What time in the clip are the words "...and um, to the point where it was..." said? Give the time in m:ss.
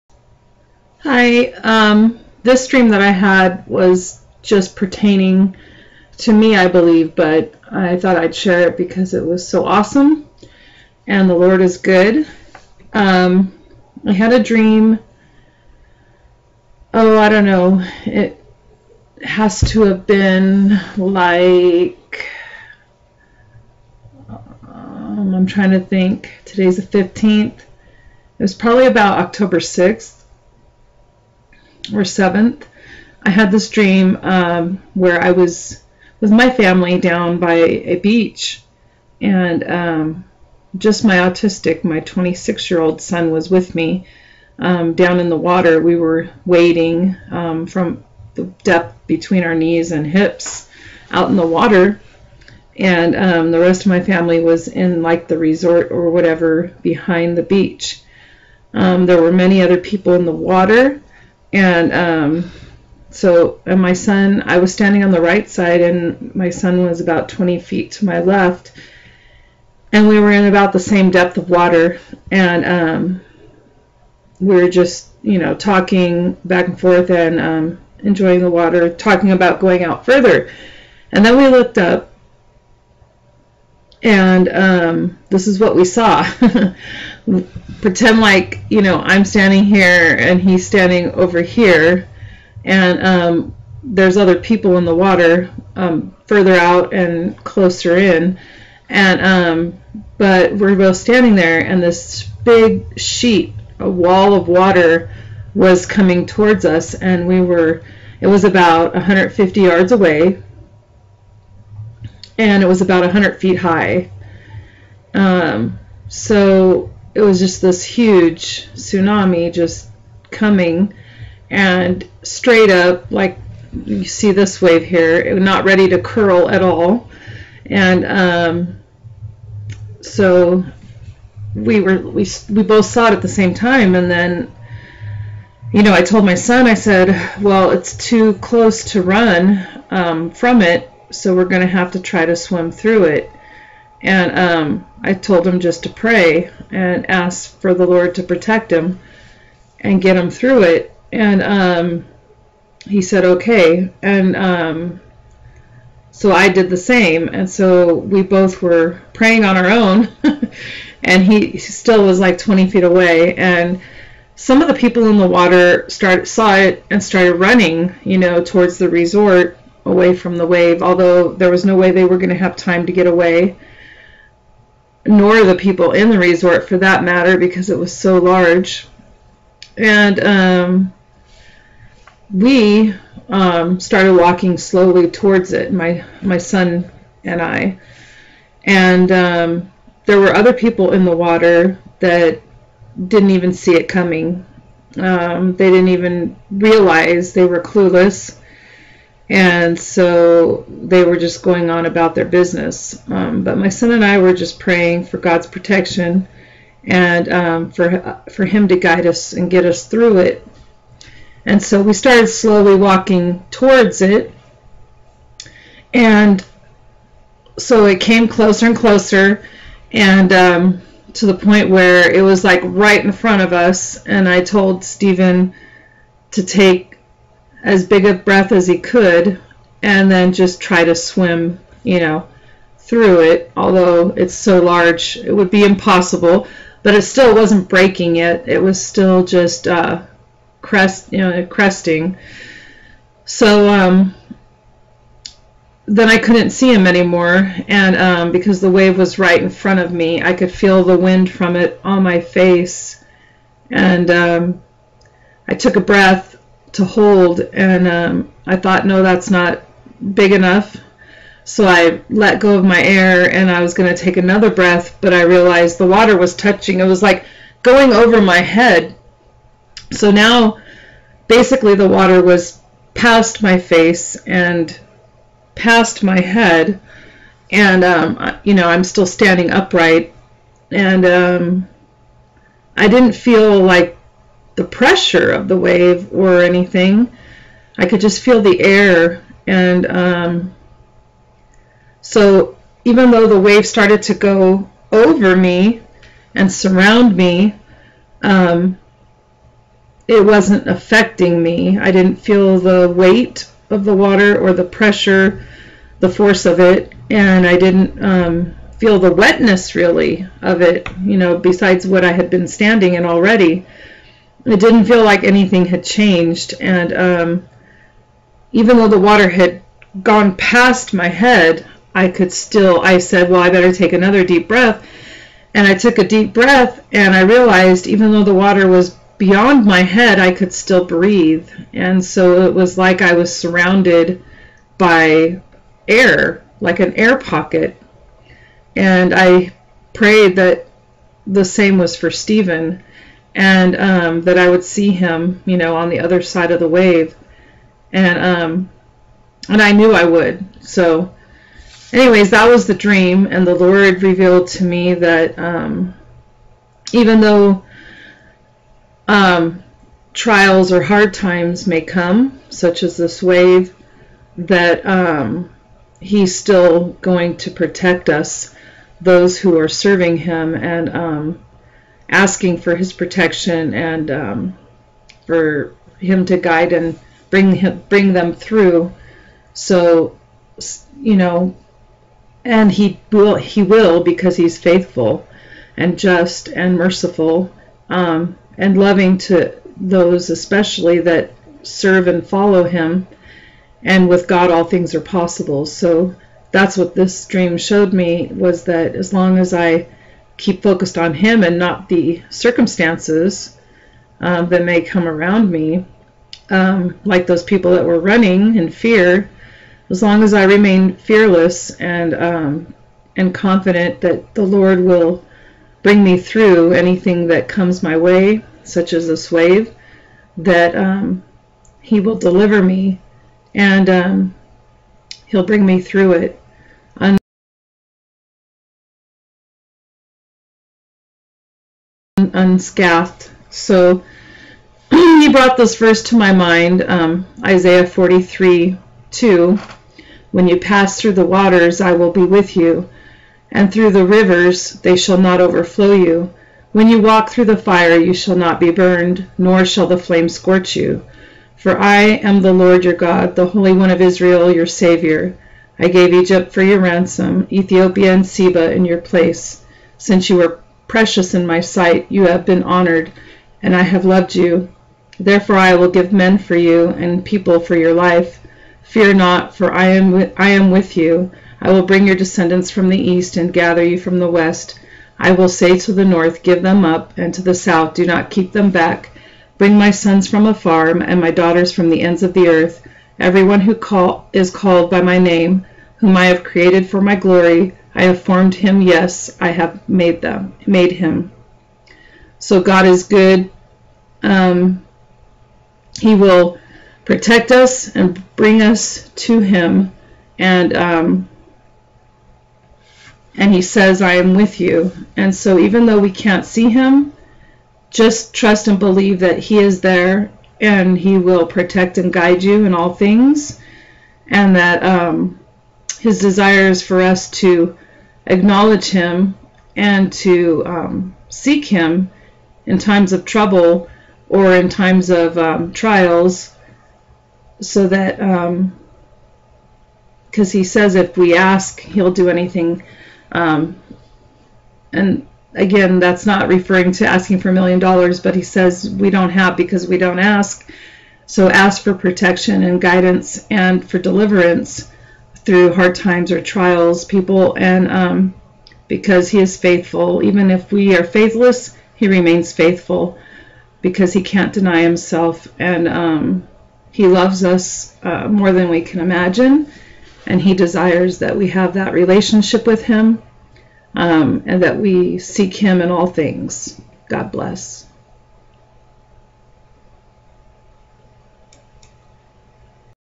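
3:39.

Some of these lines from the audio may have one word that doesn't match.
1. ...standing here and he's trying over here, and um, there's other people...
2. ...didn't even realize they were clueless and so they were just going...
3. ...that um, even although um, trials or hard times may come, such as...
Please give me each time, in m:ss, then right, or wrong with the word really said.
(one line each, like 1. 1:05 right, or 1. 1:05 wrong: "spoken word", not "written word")
1. 1:29 wrong: "standing", not "trying"
2. 3:15 right
3. 5:54 wrong: "though", not "although".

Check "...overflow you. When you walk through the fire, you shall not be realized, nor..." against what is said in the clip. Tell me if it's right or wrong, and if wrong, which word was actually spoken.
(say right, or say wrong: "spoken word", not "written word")
wrong: "burned", not "realized".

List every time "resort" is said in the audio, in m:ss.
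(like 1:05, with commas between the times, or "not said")
0:55, 2:48, 2:56.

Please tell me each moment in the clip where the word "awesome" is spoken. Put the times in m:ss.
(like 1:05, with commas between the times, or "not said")
0:09.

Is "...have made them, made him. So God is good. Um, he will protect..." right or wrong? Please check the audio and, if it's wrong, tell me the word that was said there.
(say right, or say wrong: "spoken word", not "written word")
right.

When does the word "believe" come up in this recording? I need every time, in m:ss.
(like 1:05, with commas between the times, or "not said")
0:06, 8:28.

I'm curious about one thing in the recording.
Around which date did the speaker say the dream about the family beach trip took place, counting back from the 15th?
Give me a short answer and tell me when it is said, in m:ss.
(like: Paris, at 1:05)
October 6th, at 0:29.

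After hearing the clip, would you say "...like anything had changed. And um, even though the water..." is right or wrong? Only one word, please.
right.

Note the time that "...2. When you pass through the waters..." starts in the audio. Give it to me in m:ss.
7:19.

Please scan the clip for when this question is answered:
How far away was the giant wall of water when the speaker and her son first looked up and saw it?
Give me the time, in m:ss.
1:48.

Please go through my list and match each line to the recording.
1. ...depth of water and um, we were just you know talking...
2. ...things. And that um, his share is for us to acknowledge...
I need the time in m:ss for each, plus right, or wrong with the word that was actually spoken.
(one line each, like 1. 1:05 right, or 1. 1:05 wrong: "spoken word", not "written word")
1. 1:11 right
2. 8:32 wrong: "desire", not "share".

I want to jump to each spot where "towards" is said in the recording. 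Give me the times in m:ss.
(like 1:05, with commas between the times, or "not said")
1:46, 2:48, 3:05, 3:33.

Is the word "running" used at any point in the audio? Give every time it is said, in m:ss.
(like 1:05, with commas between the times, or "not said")
2:47, 6:47.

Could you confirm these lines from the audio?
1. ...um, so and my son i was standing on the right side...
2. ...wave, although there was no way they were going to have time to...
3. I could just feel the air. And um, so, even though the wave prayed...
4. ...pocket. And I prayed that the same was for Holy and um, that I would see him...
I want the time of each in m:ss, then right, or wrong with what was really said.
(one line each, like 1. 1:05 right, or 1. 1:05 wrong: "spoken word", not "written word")
1. 1:01 right
2. 2:50 right
3. 4:47 wrong: "started", not "prayed"
4. 5:37 wrong: "Stephen", not "Holy".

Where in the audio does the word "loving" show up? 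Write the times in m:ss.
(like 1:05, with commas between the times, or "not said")
6:28.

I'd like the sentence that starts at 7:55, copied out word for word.
I will say to the north, Give them up, and to the south, Do not keep them back.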